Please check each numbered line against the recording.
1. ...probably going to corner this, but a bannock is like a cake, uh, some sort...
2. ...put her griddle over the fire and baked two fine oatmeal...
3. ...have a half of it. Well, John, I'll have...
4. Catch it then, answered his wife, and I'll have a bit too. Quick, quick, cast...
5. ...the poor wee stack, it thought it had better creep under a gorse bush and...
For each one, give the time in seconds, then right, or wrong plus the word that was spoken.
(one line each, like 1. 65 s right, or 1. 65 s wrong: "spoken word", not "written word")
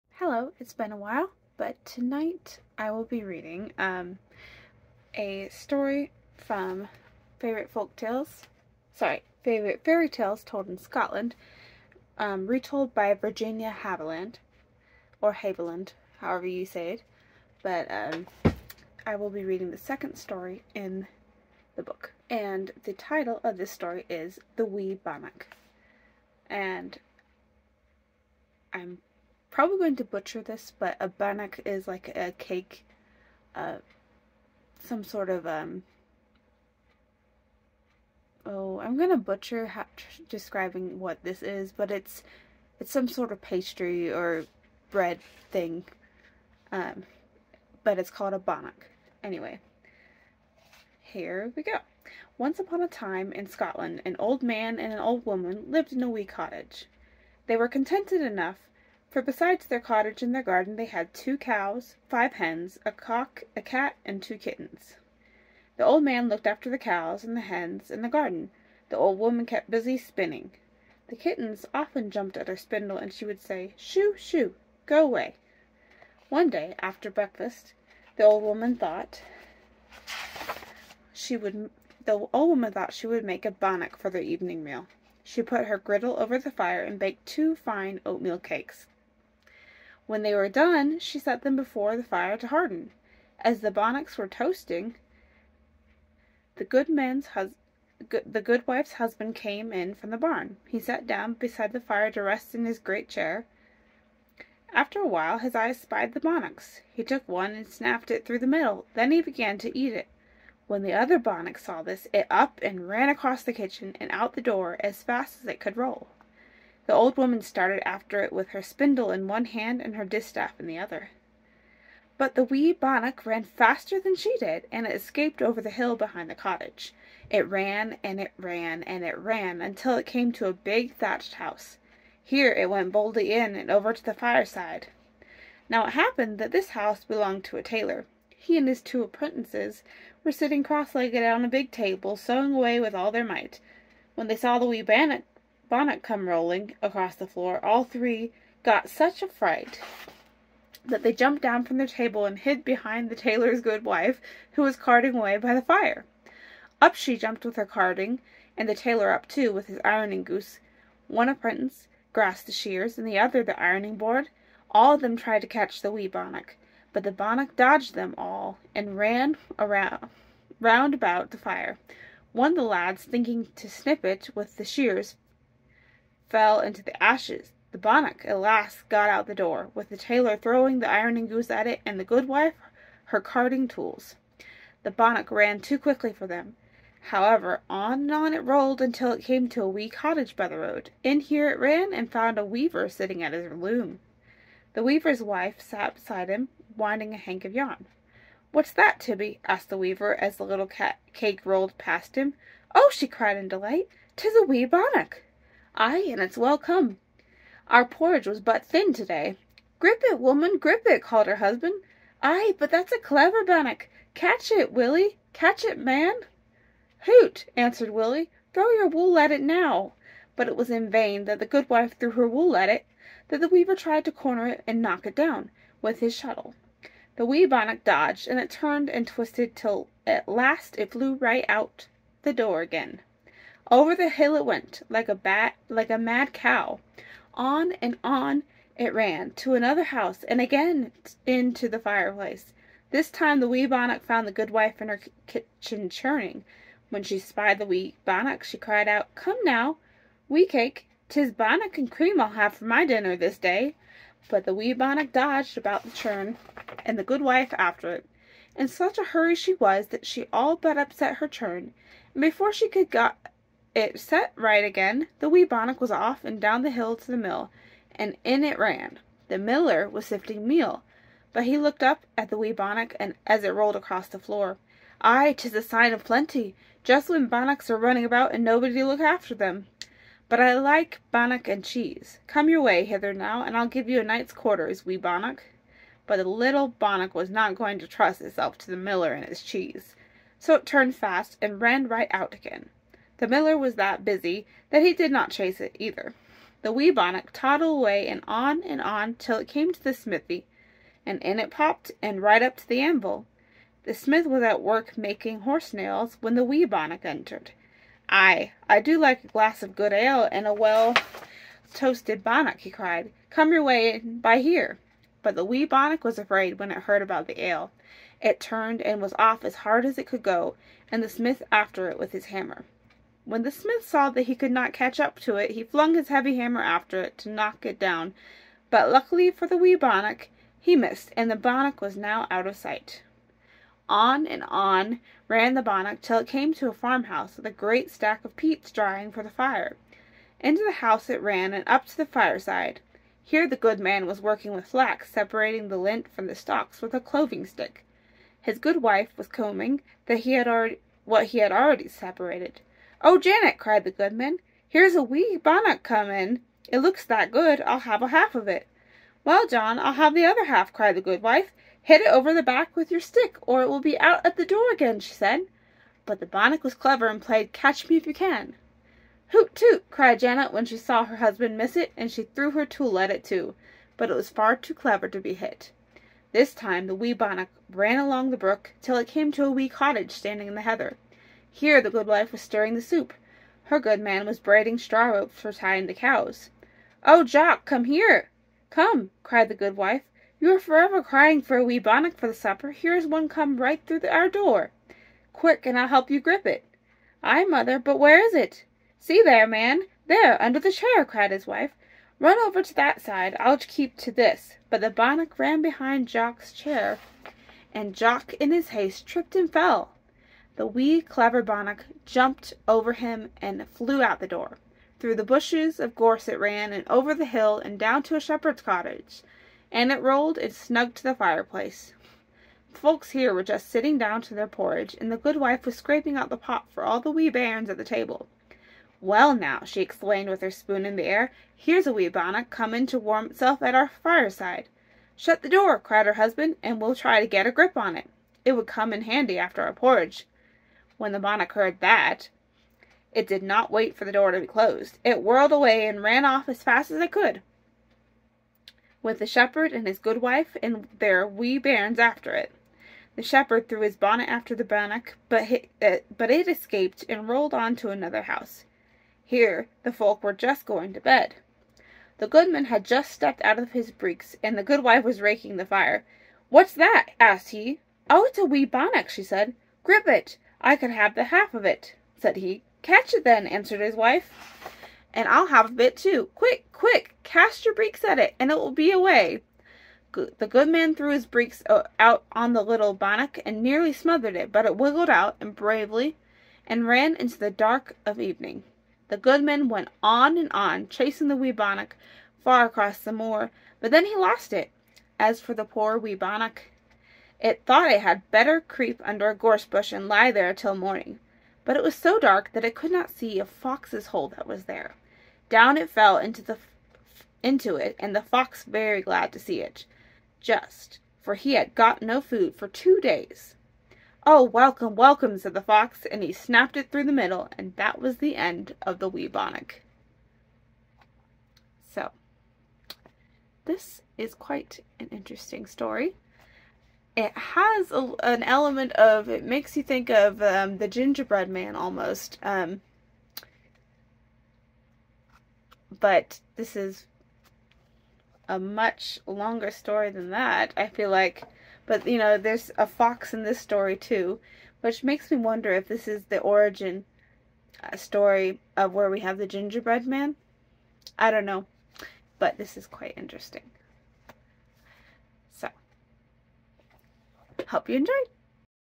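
1. 29 s wrong: "butcher", not "corner"
2. 85 s right
3. 357 s right
4. 472 s right
5. 495 s wrong: "bannock", not "stack".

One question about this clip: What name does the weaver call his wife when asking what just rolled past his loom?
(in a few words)
Tibby.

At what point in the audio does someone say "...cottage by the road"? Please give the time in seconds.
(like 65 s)
189 s.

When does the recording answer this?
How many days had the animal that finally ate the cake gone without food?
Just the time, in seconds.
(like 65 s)
512 s.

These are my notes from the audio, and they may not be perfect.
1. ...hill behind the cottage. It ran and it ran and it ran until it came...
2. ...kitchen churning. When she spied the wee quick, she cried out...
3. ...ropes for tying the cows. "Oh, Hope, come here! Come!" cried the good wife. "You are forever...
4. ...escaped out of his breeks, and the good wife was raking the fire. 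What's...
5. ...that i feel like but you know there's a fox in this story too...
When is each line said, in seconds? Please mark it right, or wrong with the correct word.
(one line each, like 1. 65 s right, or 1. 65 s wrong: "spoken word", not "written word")
1. 125 s right
2. 245 s wrong: "bannock", not "quick"
3. 385 s wrong: "Jock", not "Hope"
4. 463 s wrong: "stepped", not "escaped"
5. 540 s right.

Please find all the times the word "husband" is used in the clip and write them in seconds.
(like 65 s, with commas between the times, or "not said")
98 s, 211 s, 371 s, 436 s.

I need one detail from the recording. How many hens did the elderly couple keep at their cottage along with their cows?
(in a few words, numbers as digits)
5.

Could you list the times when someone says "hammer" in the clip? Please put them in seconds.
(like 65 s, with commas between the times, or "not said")
322 s, 326 s.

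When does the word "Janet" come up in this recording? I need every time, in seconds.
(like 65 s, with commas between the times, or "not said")
353 s, 370 s.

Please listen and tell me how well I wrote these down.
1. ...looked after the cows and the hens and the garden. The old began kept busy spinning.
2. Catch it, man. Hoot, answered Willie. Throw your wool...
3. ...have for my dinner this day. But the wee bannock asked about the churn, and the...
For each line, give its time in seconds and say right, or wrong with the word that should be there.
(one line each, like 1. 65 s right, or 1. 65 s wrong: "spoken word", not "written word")
1. 66 s wrong: "woman", not "began"
2. 215 s right
3. 252 s wrong: "dodged", not "asked".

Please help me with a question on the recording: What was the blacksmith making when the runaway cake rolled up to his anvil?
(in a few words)
Horse nails.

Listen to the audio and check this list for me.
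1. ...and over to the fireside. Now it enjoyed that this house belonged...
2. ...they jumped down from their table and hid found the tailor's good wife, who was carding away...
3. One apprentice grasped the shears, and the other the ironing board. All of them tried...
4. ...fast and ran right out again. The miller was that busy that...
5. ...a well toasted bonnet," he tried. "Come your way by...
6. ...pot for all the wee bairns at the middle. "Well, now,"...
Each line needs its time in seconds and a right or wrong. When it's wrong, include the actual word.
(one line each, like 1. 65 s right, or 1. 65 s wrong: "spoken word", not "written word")
1. 133 s wrong: "happened", not "enjoyed"
2. 151 s wrong: "behind", not "found"
3. 161 s right
4. 290 s right
5. 310 s wrong: "cried", not "tried"
6. 426 s wrong: "table", not "middle".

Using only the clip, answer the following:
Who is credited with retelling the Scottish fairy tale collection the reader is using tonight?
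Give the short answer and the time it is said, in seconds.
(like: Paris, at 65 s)
Virginia Haviland, at 13 s.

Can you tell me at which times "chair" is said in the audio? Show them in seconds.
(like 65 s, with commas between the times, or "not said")
103 s, 400 s, 406 s.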